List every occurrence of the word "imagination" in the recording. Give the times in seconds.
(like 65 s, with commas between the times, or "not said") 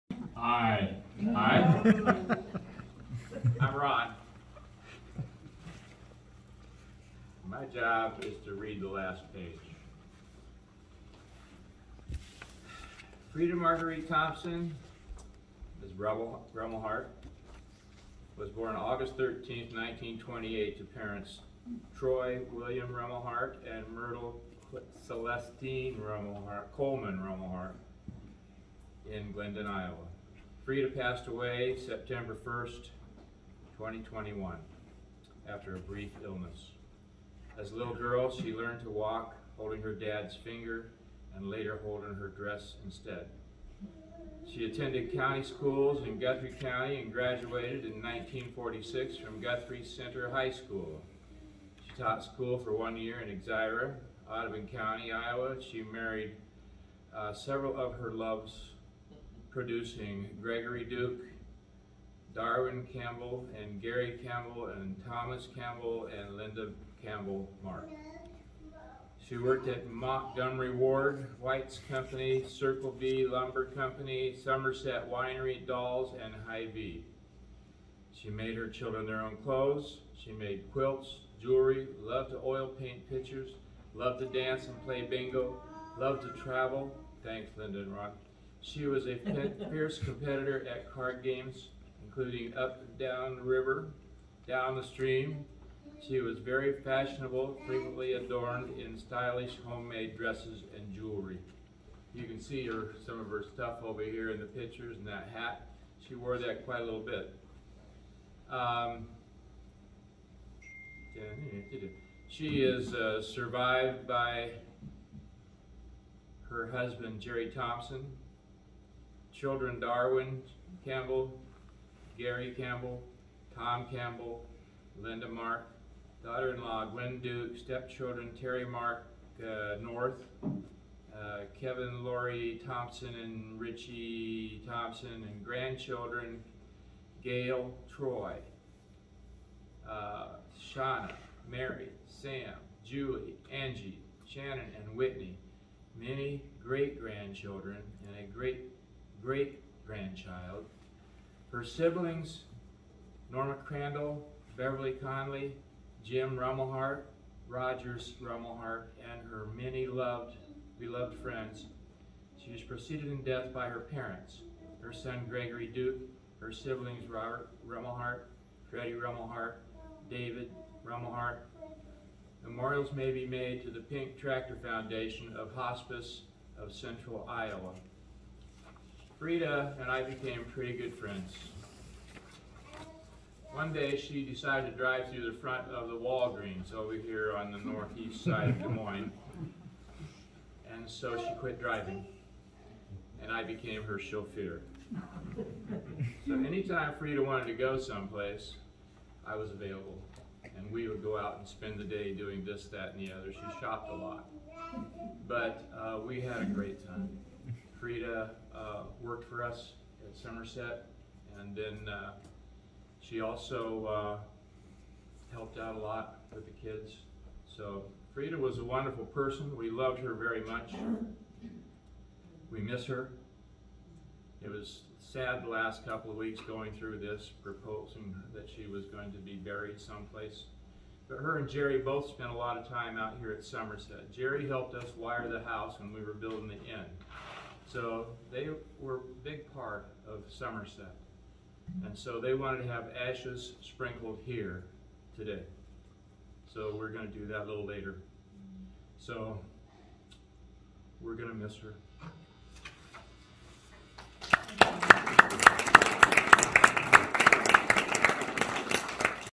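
not said.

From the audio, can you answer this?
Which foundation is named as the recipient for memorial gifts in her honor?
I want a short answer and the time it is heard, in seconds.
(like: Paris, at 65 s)
Pink Tractor Foundation, at 173 s.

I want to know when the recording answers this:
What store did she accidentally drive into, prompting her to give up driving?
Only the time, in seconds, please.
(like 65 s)
185 s.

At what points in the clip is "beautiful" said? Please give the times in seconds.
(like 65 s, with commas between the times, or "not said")
not said.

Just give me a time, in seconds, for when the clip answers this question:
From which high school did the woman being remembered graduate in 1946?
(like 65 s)
49 s.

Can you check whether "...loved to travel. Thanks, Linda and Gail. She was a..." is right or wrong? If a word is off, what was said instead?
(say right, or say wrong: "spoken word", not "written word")
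wrong: "Ron", not "Gail".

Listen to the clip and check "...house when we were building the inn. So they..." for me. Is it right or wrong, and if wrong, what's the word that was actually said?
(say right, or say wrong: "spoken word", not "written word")
right.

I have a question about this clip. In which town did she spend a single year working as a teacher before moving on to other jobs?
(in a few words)
Exira.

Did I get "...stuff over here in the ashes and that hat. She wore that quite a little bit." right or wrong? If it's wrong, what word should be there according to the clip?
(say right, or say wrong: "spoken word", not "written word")
wrong: "pictures", not "ashes".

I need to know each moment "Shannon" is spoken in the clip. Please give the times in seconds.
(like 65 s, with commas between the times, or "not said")
144 s.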